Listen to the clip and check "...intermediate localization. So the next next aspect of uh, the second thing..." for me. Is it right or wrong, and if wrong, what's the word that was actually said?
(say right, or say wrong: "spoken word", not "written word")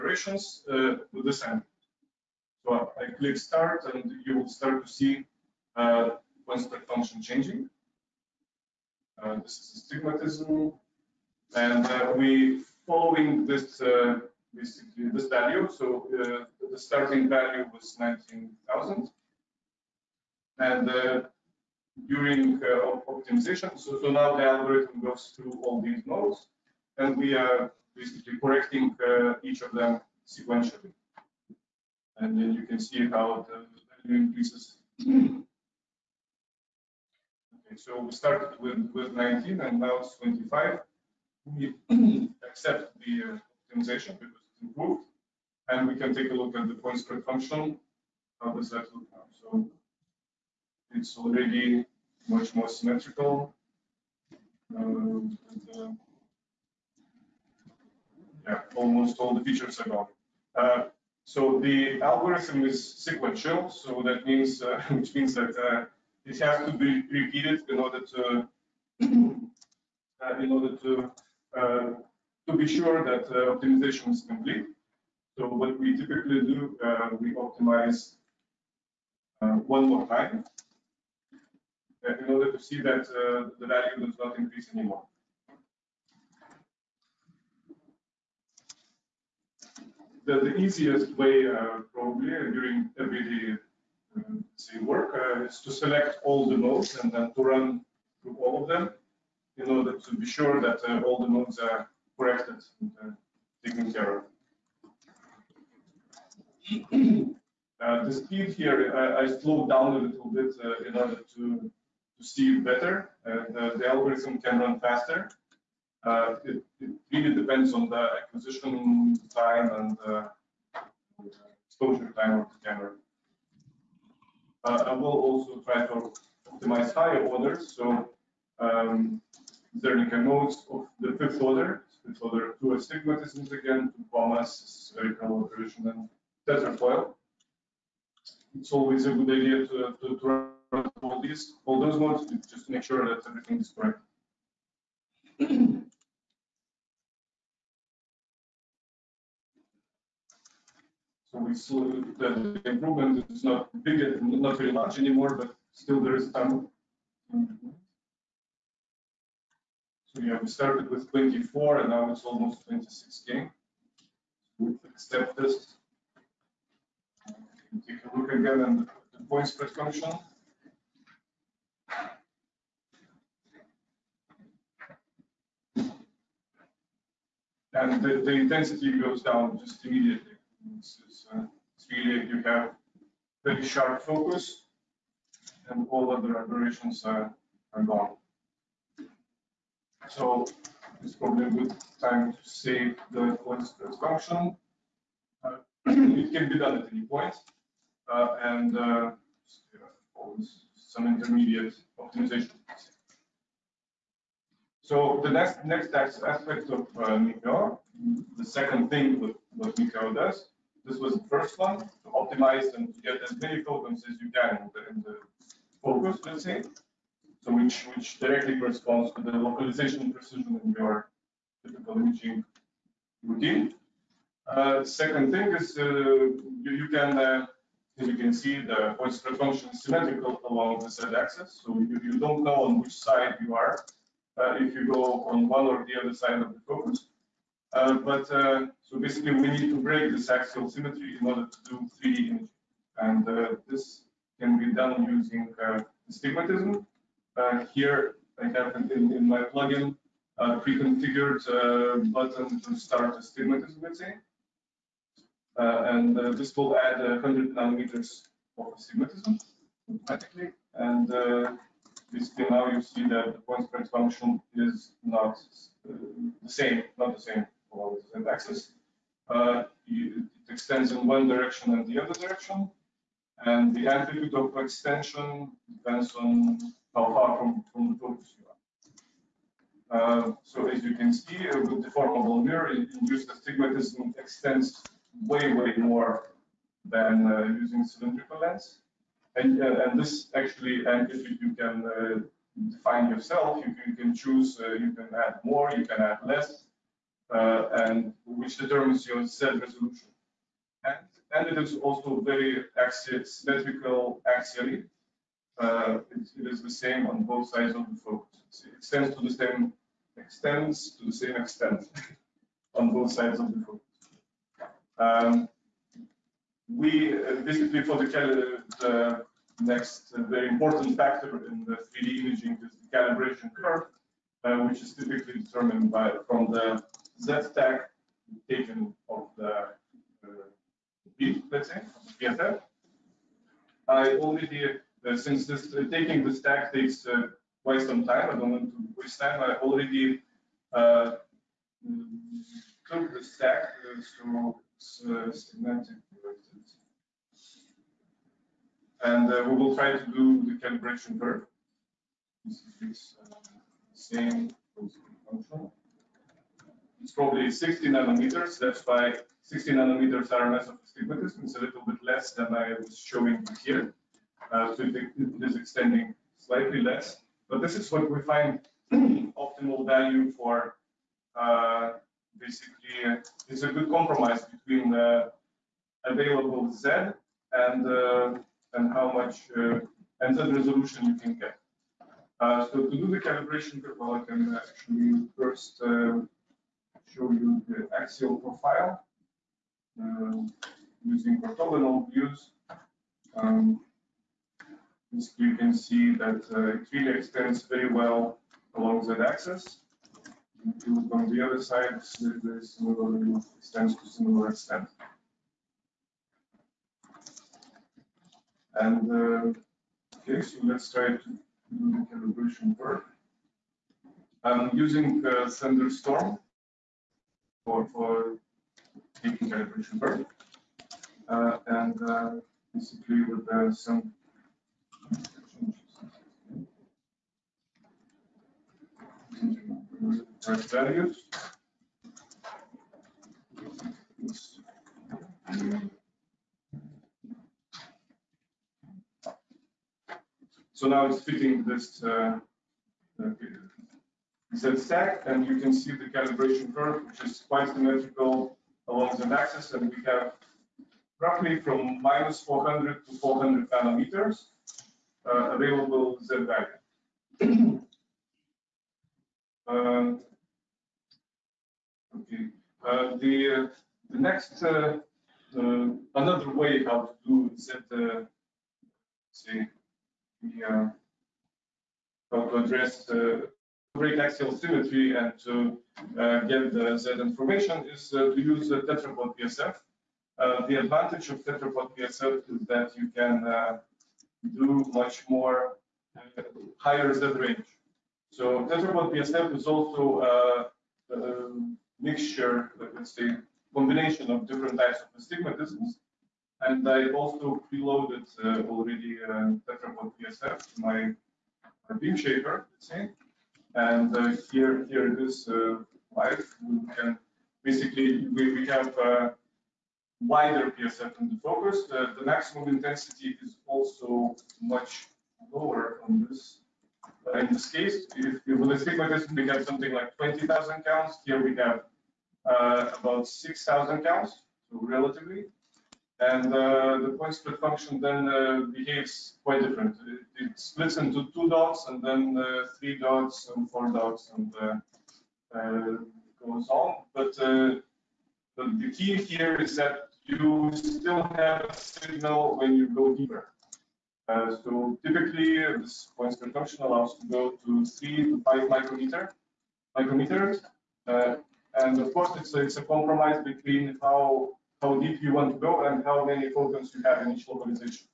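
wrong: "optimization", not "localization".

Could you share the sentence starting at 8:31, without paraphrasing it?
The, the, maximum intensity is also much lower on this.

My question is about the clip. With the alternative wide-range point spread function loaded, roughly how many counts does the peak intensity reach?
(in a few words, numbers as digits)
6,000.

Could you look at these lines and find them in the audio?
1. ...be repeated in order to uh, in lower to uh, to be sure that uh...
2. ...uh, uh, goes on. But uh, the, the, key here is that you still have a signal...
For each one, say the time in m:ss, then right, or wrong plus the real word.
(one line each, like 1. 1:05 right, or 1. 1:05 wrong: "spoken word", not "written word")
1. 1:06 wrong: "order", not "lower"
2. 8:54 right.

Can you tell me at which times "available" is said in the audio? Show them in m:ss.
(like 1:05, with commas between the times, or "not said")
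6:16, 7:35.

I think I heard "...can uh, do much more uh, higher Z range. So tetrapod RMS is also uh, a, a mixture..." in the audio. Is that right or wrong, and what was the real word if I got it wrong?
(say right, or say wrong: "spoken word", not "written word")
wrong: "PSF", not "RMS".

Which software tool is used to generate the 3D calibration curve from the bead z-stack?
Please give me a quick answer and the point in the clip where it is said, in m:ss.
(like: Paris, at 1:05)
ThunderSTORM, at 6:55.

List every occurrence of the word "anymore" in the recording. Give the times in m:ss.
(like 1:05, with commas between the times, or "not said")
1:24, 2:34.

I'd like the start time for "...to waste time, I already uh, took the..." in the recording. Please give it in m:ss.
5:38.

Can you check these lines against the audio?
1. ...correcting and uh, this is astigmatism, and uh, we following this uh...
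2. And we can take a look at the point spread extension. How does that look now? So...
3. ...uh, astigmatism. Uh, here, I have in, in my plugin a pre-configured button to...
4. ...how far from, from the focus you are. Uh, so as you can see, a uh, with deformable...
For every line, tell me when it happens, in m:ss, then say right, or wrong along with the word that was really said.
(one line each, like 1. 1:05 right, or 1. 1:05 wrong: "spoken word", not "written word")
1. 0:07 wrong: "changing", not "correcting"
2. 0:45 wrong: "function", not "extension"
3. 4:05 right
4. 4:36 right.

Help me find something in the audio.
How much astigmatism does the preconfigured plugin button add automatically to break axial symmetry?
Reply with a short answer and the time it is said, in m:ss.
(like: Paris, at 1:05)
100 nanometers, at 4:16.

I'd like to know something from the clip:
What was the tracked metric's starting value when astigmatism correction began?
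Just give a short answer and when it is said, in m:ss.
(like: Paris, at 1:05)
19,000, at 0:17.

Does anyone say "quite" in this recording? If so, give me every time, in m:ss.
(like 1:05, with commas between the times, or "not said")
5:37, 7:27, 8:49.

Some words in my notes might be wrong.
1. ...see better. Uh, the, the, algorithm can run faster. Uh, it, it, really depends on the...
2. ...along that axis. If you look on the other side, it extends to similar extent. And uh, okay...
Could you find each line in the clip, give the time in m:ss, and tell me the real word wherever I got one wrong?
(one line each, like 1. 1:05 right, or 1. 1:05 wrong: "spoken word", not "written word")
1. 1:52 right
2. 6:38 right.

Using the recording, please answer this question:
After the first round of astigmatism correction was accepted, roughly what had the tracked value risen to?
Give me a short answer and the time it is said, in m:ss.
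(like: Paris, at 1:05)
25, at 0:40.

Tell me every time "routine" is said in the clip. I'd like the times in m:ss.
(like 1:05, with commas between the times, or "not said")
3:43.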